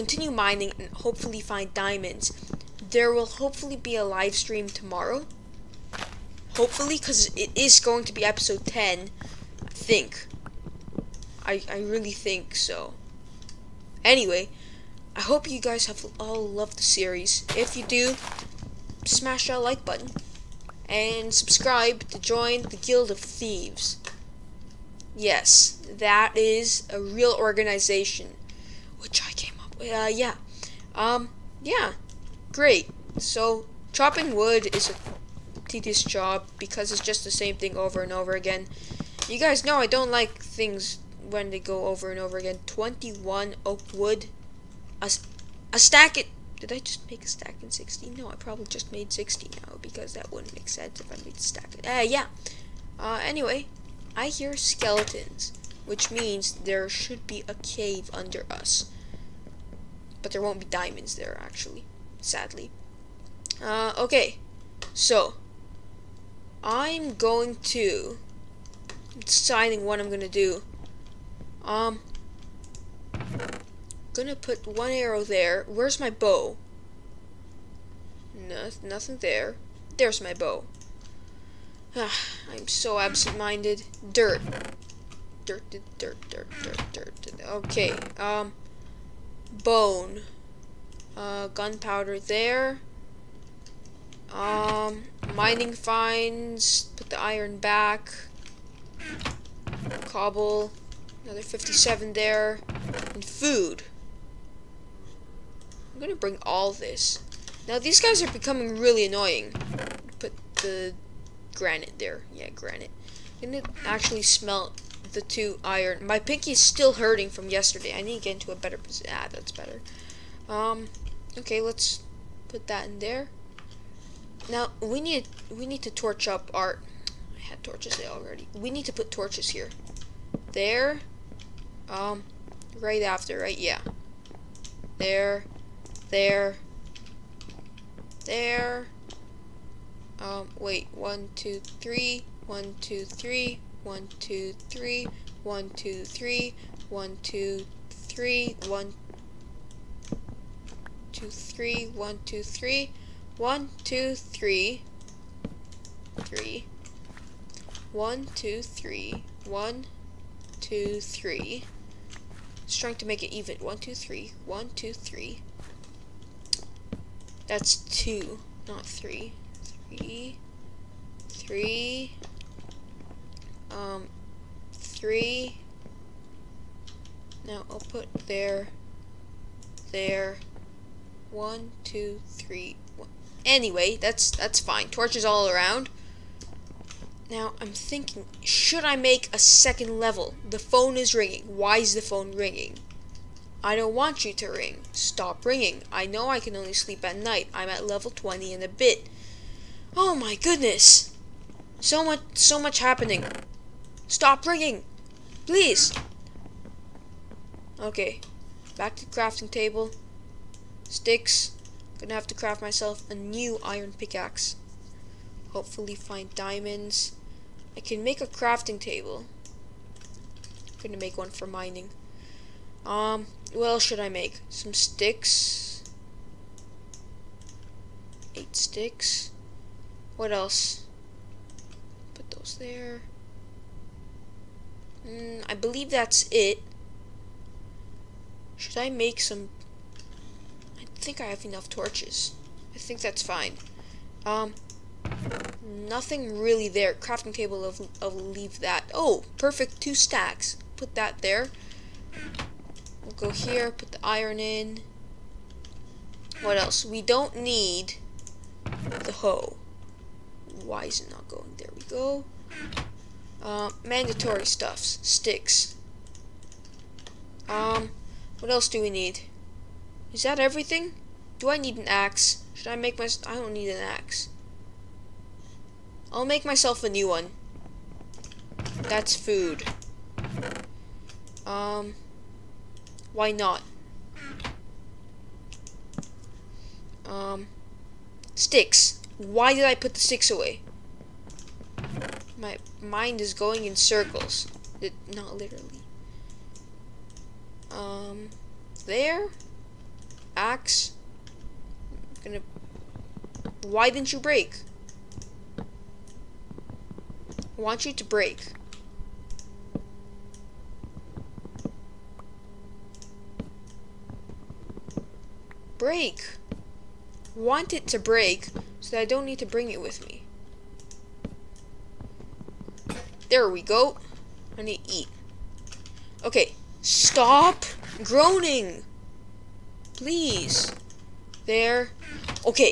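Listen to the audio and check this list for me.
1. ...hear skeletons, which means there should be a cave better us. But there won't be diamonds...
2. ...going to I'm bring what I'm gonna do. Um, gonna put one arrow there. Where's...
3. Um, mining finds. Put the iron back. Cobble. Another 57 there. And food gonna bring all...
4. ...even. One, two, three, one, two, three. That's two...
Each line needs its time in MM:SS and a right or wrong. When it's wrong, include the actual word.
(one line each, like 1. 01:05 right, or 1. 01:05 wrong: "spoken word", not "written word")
1. 00:54 wrong: "under", not "better"
2. 01:07 wrong: "deciding", not "bring"
3. 01:34 right
4. 02:43 right.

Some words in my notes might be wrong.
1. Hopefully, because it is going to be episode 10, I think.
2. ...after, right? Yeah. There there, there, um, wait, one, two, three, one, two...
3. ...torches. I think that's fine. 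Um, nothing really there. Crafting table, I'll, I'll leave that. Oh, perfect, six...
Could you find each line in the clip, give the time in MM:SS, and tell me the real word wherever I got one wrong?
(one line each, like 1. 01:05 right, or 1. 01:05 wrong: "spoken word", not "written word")
1. 00:06 right
2. 02:13 right
3. 04:01 wrong: "two", not "six".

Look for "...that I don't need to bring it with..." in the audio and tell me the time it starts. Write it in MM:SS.
05:18.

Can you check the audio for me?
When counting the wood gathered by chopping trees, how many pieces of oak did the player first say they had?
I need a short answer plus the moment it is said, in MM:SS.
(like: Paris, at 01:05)
21, at 00:42.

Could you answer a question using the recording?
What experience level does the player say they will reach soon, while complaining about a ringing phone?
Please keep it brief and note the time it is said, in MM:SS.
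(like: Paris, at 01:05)
20, at 03:17.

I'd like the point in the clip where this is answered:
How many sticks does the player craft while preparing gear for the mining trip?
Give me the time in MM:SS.
03:48.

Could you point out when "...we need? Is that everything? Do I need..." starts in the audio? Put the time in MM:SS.
04:28.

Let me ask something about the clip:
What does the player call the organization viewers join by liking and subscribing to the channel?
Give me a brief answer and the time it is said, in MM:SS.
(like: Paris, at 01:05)
Guild of Thieves, at 00:22.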